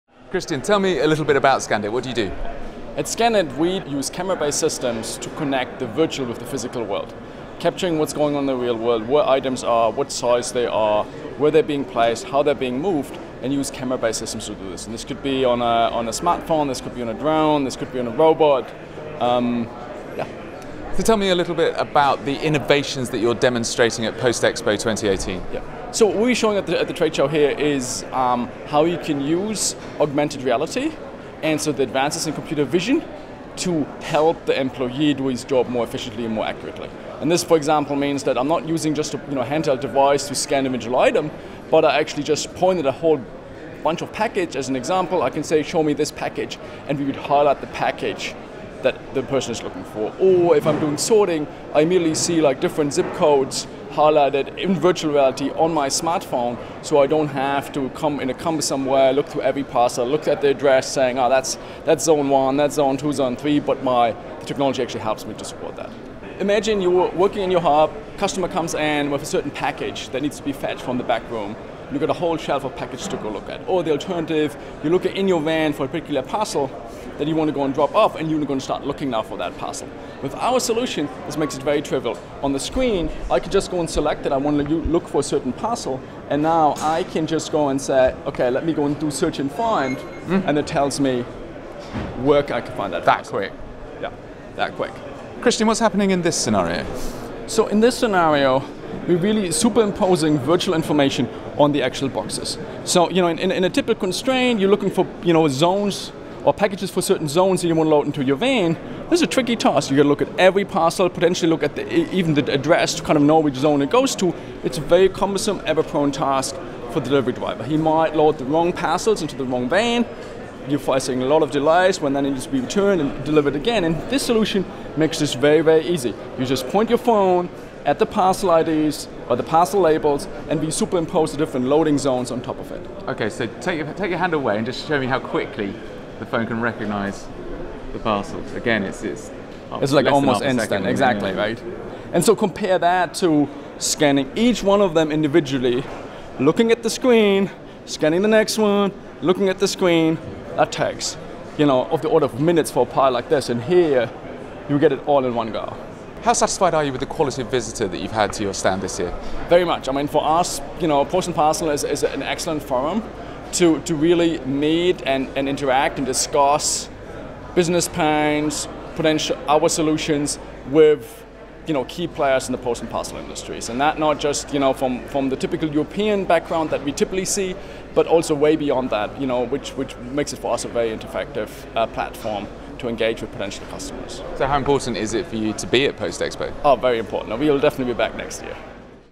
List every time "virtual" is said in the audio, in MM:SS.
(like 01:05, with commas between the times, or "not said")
00:05, 00:54, 01:40.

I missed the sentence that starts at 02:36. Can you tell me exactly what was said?
How satisfied are you with the quality of visitor that you've had to your stand this year?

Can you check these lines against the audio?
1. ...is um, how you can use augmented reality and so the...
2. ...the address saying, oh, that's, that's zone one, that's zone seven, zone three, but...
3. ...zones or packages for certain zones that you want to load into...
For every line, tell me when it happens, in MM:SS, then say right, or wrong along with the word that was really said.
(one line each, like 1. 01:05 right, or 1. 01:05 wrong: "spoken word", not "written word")
1. 00:27 right
2. 01:00 wrong: "two", not "seven"
3. 01:45 right.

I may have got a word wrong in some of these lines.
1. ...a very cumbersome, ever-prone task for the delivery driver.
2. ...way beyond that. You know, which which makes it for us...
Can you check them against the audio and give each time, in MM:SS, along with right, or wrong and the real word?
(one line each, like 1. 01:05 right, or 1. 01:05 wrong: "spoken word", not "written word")
1. 01:54 right
2. 02:58 right.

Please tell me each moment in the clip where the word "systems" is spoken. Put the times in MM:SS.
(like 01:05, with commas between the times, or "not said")
00:04, 00:14.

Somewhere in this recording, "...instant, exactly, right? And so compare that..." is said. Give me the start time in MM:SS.
02:20.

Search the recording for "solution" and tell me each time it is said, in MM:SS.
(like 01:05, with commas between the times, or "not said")
01:20, 02:04, 02:49.